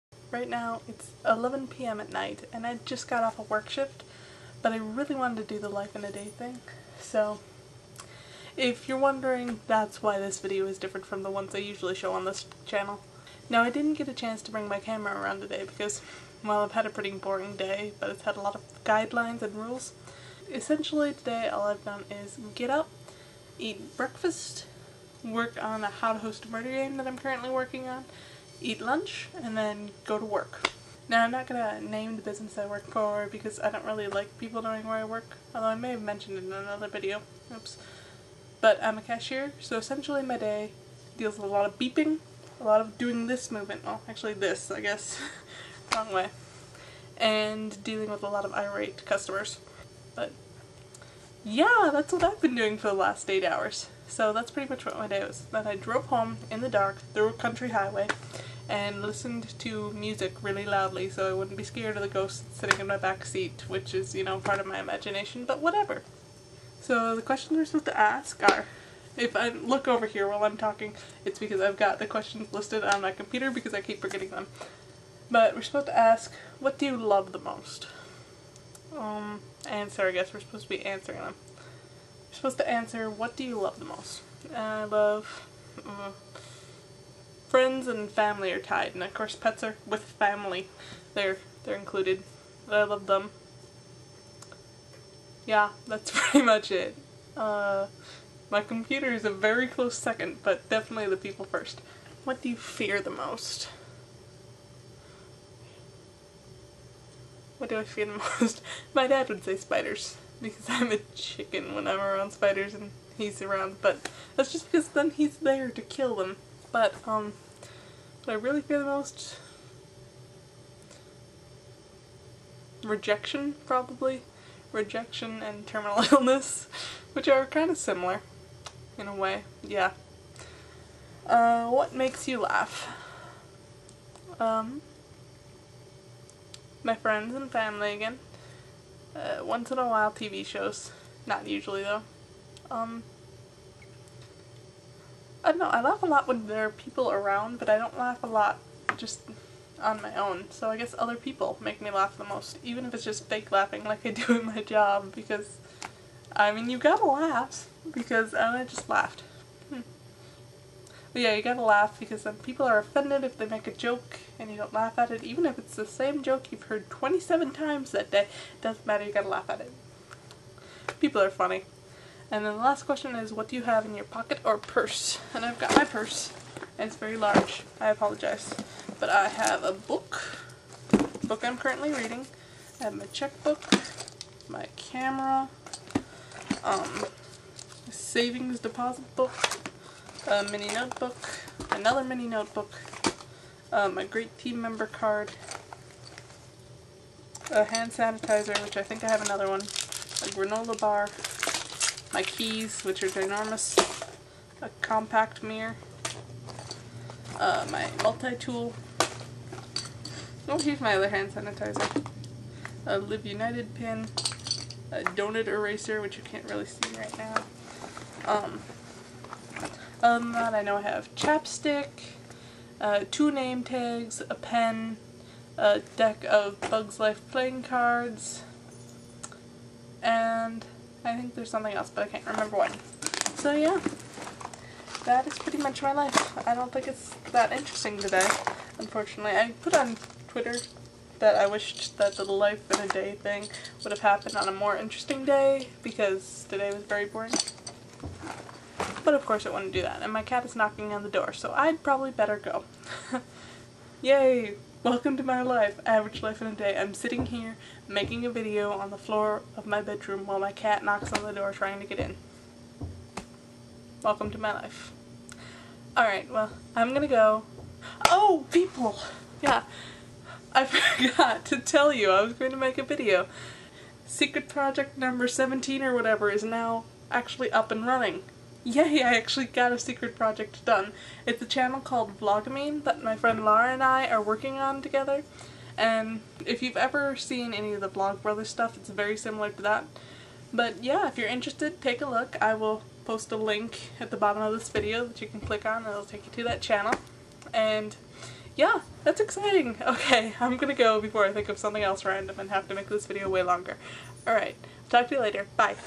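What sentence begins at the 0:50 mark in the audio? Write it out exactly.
But yeah, that's what I've been doing for the last eight hours.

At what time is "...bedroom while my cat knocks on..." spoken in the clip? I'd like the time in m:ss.
4:19.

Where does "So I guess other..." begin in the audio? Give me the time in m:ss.
2:30.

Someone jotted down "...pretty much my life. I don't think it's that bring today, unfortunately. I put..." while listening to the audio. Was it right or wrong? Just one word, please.
wrong.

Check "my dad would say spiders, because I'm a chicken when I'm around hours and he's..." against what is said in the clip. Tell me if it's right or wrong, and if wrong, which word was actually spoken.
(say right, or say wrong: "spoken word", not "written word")
wrong: "spiders", not "hours".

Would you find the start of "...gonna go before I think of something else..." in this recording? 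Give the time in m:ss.
5:00.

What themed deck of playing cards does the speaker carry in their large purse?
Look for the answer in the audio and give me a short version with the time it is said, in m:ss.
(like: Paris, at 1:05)
Bugs Life, at 3:46.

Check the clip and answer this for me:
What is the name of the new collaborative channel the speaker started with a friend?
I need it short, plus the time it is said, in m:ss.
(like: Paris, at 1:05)
Vlogamine, at 4:42.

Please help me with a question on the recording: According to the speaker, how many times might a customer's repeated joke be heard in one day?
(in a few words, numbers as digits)
27.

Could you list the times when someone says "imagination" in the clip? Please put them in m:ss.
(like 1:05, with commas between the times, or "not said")
1:04.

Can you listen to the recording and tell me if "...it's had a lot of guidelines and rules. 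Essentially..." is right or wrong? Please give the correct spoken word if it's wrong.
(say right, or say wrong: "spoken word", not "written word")
right.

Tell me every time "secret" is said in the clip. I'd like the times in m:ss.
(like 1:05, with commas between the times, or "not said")
4:34, 4:39.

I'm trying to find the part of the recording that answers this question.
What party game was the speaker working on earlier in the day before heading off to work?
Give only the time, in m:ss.
0:25.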